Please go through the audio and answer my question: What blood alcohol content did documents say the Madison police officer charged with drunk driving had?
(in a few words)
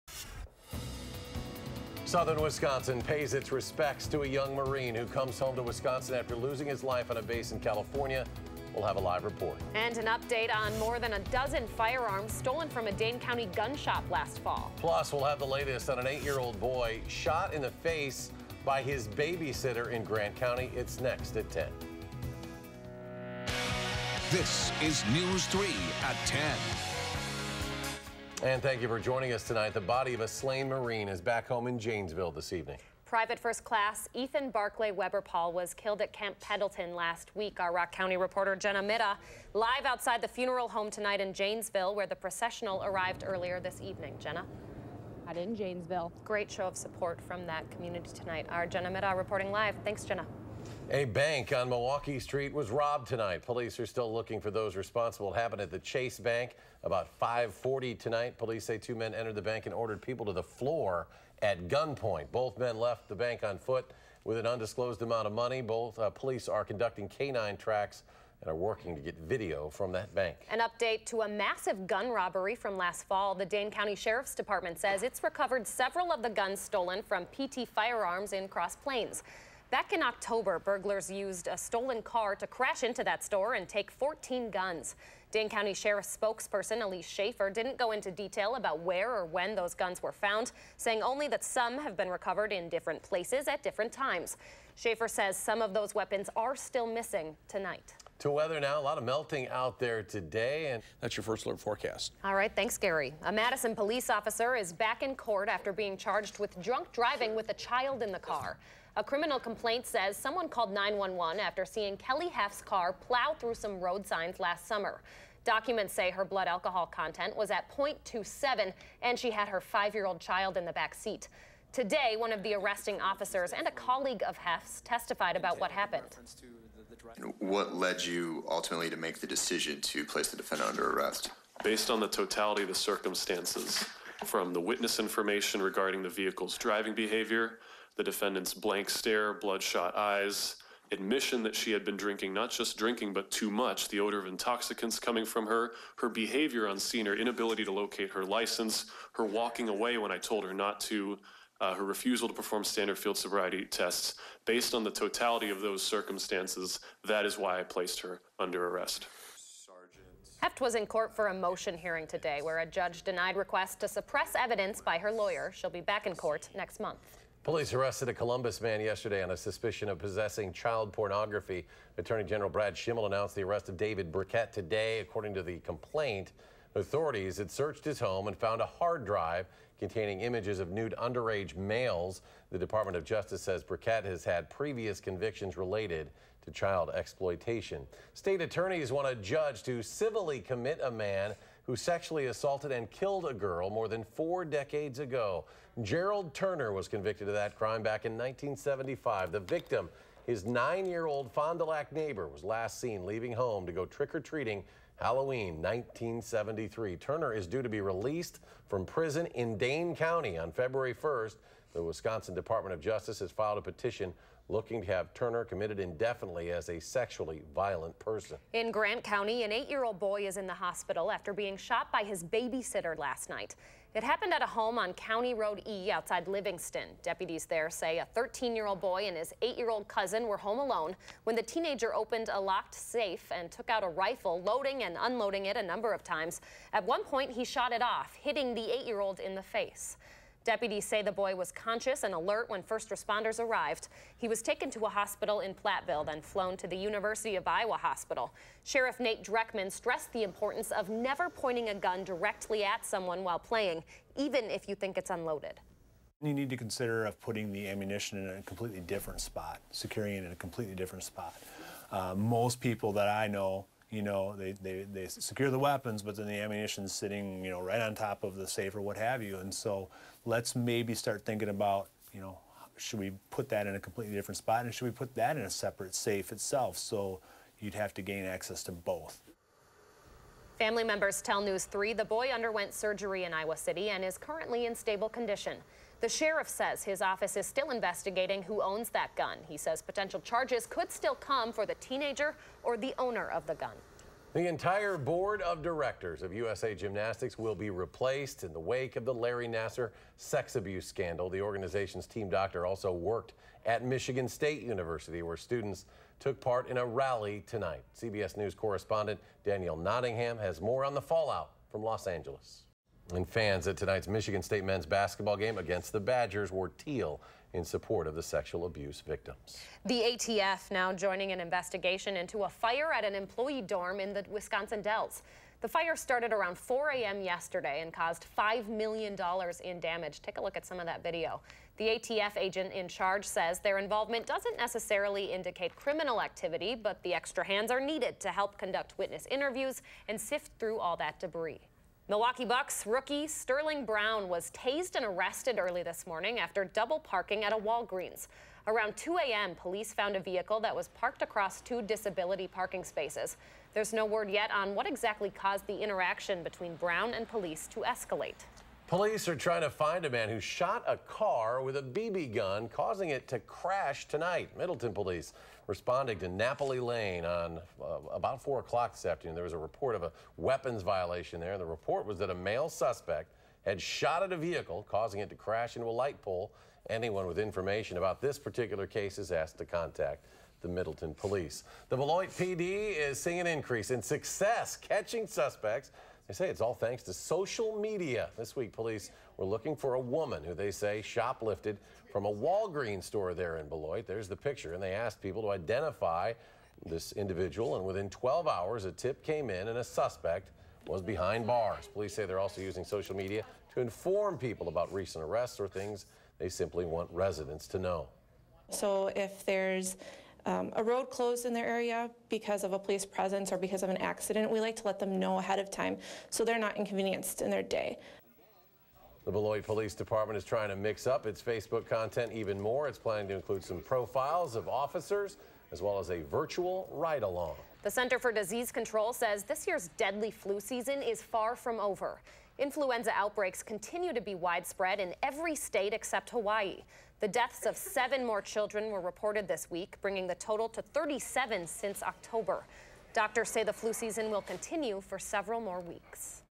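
0.27.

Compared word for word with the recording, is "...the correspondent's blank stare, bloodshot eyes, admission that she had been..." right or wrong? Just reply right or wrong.
wrong.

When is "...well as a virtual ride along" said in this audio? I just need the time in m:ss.
7:05.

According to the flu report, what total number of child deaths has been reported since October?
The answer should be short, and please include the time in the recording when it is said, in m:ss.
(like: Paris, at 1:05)
37, at 7:20.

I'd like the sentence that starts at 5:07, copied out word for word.
CBS News correspondent Danielle Nottingham has more on the fallout from Los Angeles.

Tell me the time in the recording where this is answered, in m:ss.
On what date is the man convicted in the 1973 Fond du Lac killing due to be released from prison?
3:30.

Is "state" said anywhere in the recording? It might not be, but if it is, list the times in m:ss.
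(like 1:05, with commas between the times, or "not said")
3:08, 5:04, 5:14, 7:15.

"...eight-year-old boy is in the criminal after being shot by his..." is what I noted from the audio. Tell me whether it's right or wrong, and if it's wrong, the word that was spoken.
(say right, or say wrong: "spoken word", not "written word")
wrong: "hospital", not "criminal".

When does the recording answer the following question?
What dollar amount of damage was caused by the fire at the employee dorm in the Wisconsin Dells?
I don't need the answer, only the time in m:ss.
5:28.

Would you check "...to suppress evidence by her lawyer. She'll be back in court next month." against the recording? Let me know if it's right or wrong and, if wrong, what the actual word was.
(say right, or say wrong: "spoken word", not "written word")
right.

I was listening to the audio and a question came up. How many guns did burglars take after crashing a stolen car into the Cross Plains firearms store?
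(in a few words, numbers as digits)
14.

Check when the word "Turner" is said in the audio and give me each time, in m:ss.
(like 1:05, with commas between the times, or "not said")
3:16, 3:26, 3:35.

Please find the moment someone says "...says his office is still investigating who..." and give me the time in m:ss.
4:46.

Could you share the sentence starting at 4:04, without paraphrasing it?
He was taken to a hospital in Platteville, then flown to the University of Iowa Hospital.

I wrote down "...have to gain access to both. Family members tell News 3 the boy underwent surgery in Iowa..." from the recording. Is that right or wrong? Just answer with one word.
right.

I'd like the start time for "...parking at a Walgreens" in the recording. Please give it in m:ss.
5:46.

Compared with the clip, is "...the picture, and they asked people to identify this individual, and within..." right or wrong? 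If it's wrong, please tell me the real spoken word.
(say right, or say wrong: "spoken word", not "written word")
right.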